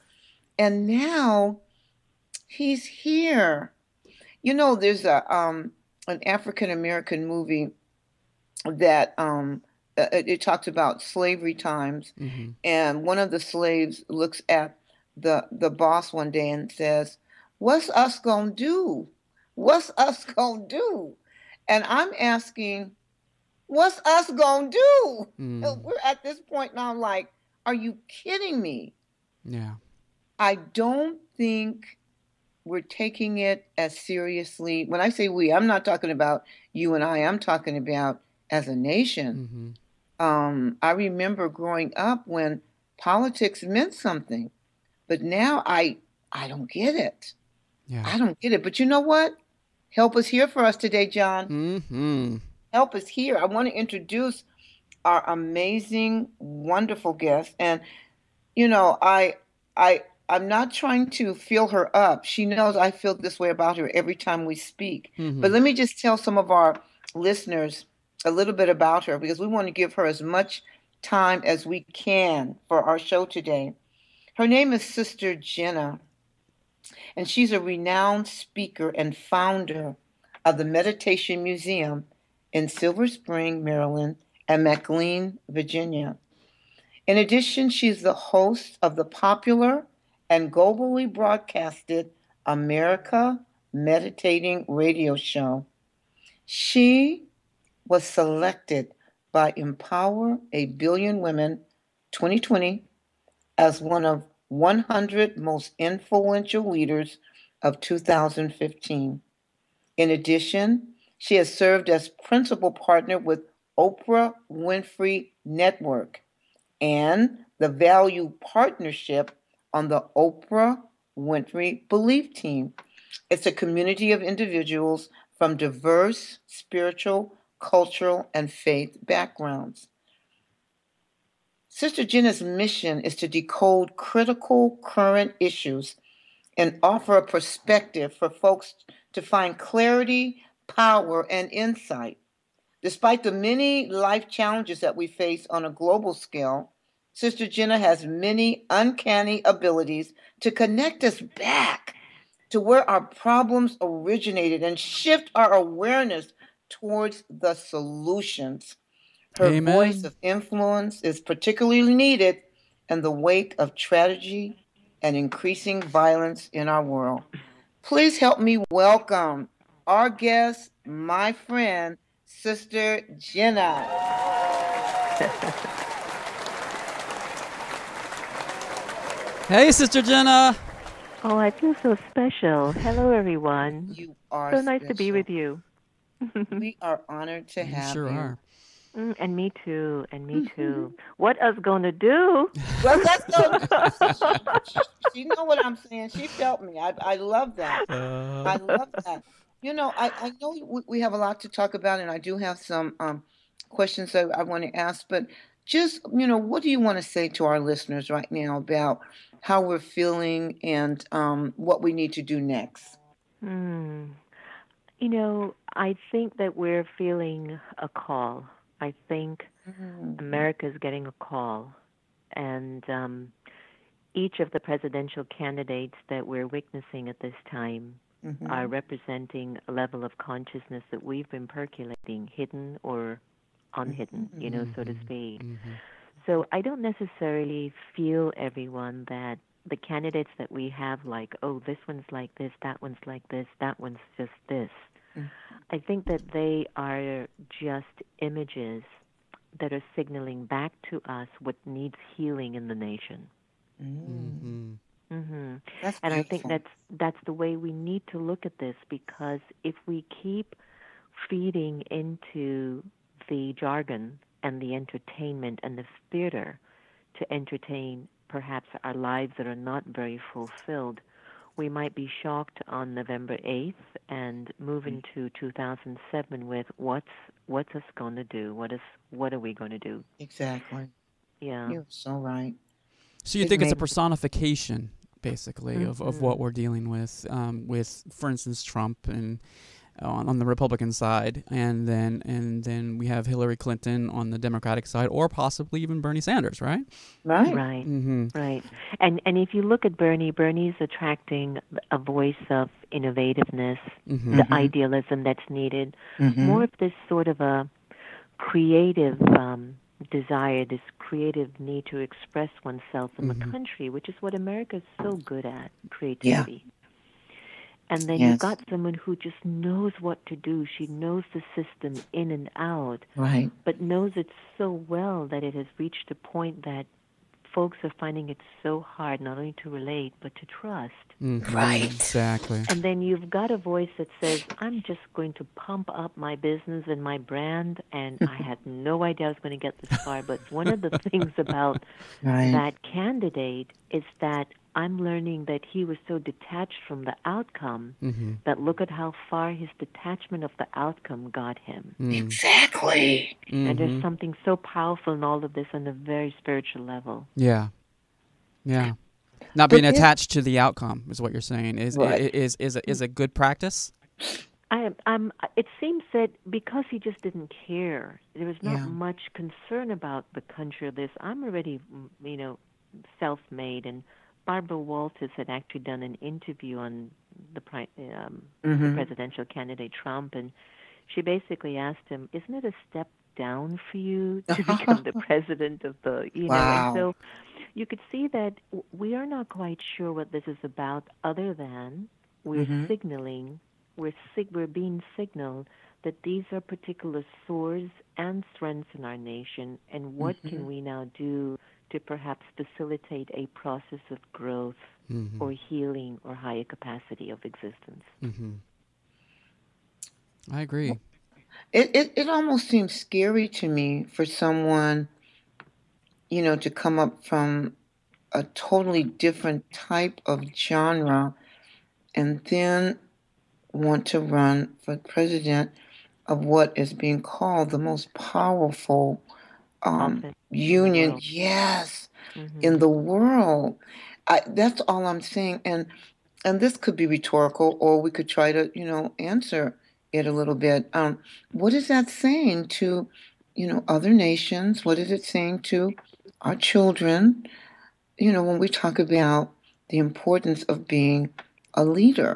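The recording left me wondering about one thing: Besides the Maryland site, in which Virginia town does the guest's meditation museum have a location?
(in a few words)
McLean.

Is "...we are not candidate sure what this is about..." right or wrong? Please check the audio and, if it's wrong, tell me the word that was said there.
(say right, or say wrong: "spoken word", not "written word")
wrong: "quite", not "candidate".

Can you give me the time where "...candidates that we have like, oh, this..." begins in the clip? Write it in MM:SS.
03:59.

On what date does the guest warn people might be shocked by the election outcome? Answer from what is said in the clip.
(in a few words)
November 8th.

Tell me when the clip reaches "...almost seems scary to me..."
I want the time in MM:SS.
06:52.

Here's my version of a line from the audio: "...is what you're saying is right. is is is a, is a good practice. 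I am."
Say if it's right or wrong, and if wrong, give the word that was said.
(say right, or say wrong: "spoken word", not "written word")
right.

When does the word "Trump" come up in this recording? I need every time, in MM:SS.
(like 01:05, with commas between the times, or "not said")
04:48, 06:19.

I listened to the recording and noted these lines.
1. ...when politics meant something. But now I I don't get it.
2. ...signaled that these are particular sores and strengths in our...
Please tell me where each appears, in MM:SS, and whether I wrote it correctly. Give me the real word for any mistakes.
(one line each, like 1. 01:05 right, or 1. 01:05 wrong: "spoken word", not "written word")
1. 00:42 right
2. 06:35 right.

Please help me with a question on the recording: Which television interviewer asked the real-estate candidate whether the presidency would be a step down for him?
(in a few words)
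Barbara Walters.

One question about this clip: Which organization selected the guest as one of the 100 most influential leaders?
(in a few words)
Empower a Billion Women 2020.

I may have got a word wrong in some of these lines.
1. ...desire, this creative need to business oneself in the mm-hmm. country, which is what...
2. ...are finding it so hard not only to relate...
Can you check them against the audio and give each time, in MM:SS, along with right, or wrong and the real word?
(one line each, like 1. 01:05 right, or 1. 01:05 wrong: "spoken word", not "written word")
1. 05:10 wrong: "express", not "business"
2. 05:27 right.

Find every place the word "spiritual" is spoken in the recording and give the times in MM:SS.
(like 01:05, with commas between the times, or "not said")
02:06, 05:56.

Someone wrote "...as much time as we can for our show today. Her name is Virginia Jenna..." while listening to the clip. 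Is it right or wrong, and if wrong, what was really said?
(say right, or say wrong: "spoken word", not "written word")
wrong: "Sister", not "Virginia".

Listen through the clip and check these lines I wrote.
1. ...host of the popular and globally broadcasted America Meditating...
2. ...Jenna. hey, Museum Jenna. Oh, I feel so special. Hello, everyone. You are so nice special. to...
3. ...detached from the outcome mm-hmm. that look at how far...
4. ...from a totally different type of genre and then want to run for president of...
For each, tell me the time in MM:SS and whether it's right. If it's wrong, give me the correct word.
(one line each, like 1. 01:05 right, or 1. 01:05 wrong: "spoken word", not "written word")
1. 01:28 right
2. 02:53 wrong: "Sister", not "Museum"
3. 05:46 right
4. 06:57 right.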